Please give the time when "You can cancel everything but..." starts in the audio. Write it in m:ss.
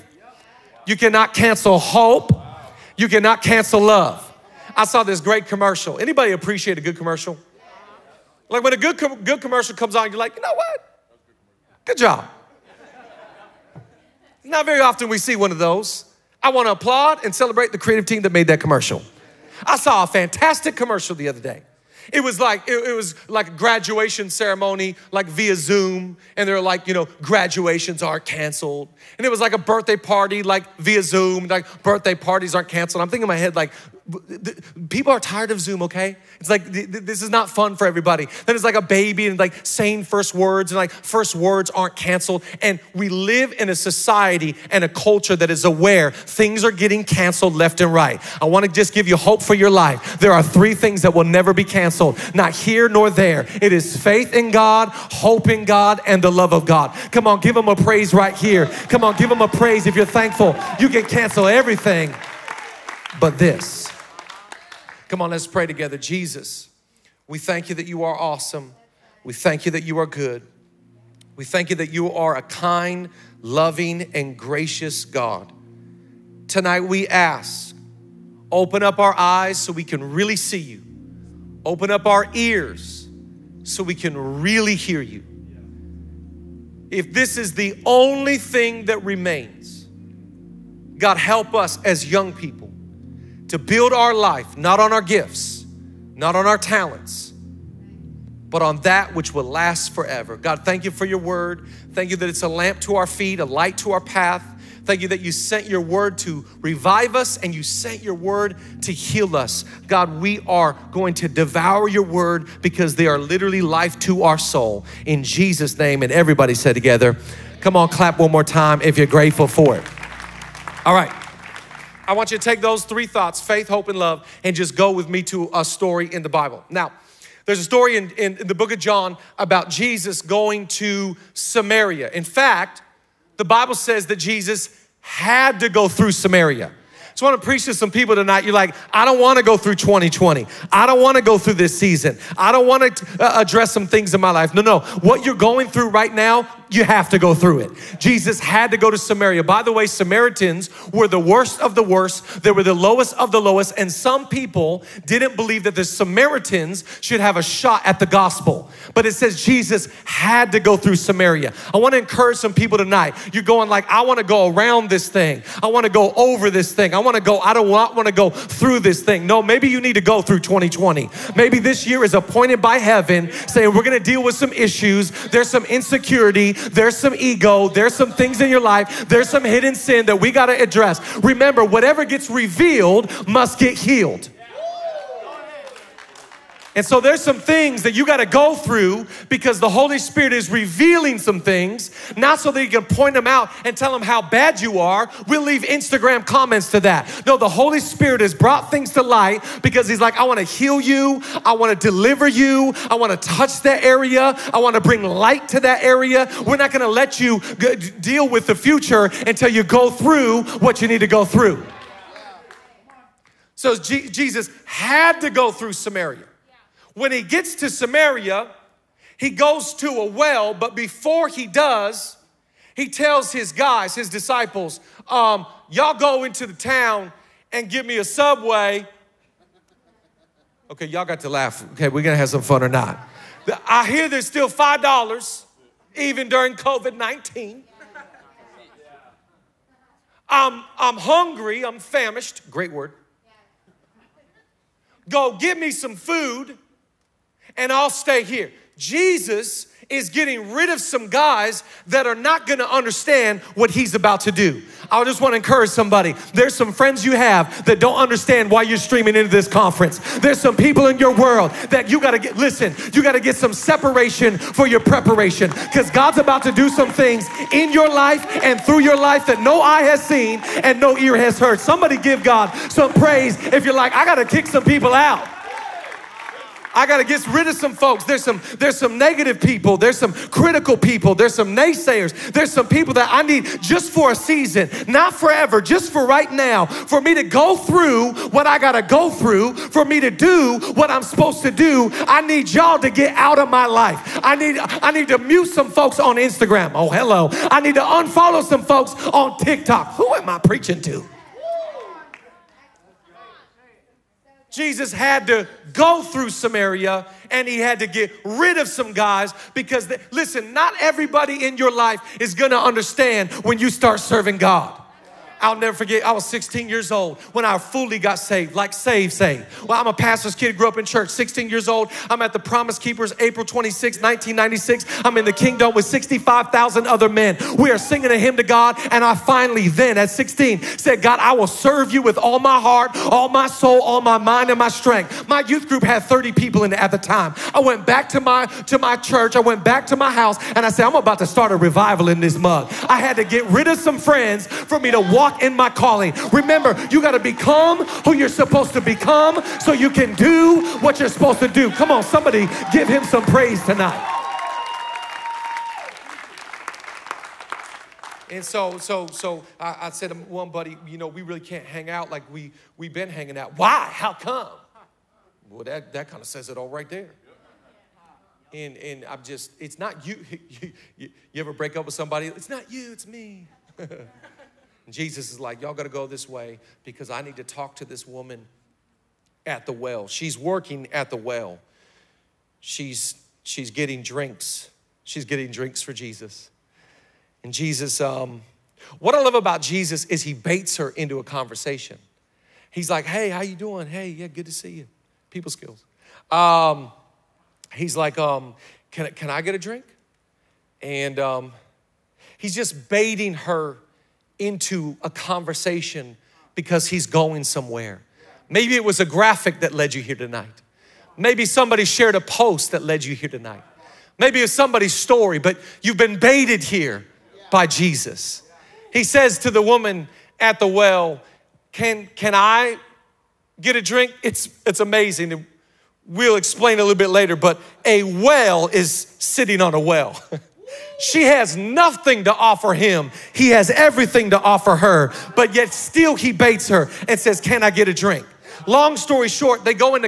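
1:00.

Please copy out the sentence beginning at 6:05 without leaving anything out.
Well, that that kind of says it all right there.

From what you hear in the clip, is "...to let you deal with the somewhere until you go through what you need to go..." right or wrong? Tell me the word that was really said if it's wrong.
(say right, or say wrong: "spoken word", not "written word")
wrong: "future", not "somewhere".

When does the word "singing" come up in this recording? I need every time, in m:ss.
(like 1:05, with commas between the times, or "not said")
5:27.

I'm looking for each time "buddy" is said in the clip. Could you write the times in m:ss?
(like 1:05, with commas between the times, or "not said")
6:00.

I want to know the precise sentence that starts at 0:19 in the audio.
I saw a fantastic commercial the other day.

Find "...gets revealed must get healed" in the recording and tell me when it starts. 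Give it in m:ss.
3:02.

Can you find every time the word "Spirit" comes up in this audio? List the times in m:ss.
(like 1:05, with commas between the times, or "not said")
3:09, 3:17.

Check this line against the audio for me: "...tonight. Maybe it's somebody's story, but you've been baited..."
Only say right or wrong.
right.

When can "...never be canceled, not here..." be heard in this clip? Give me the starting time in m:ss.
0:51.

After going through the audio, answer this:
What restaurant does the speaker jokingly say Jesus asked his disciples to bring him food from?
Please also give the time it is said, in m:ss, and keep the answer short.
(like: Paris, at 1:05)
Subway, at 3:48.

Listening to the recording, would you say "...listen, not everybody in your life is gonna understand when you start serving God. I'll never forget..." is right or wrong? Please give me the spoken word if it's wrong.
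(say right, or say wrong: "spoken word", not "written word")
right.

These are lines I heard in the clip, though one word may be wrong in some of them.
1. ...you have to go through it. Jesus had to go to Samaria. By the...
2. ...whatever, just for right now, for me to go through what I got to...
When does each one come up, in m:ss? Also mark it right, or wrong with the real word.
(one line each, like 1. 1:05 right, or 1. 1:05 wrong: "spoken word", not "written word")
1. 2:26 right
2. 4:45 wrong: "forever", not "whatever".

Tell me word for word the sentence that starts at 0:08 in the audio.
Like when a good, com good commercial comes on, you're like, you know what?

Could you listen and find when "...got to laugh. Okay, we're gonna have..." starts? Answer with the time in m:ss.
3:51.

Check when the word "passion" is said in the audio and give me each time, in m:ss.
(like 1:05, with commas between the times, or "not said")
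not said.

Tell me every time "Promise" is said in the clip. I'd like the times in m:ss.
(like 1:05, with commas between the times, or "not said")
5:22.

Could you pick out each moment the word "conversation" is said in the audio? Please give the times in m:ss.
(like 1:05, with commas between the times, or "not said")
6:31, 6:45.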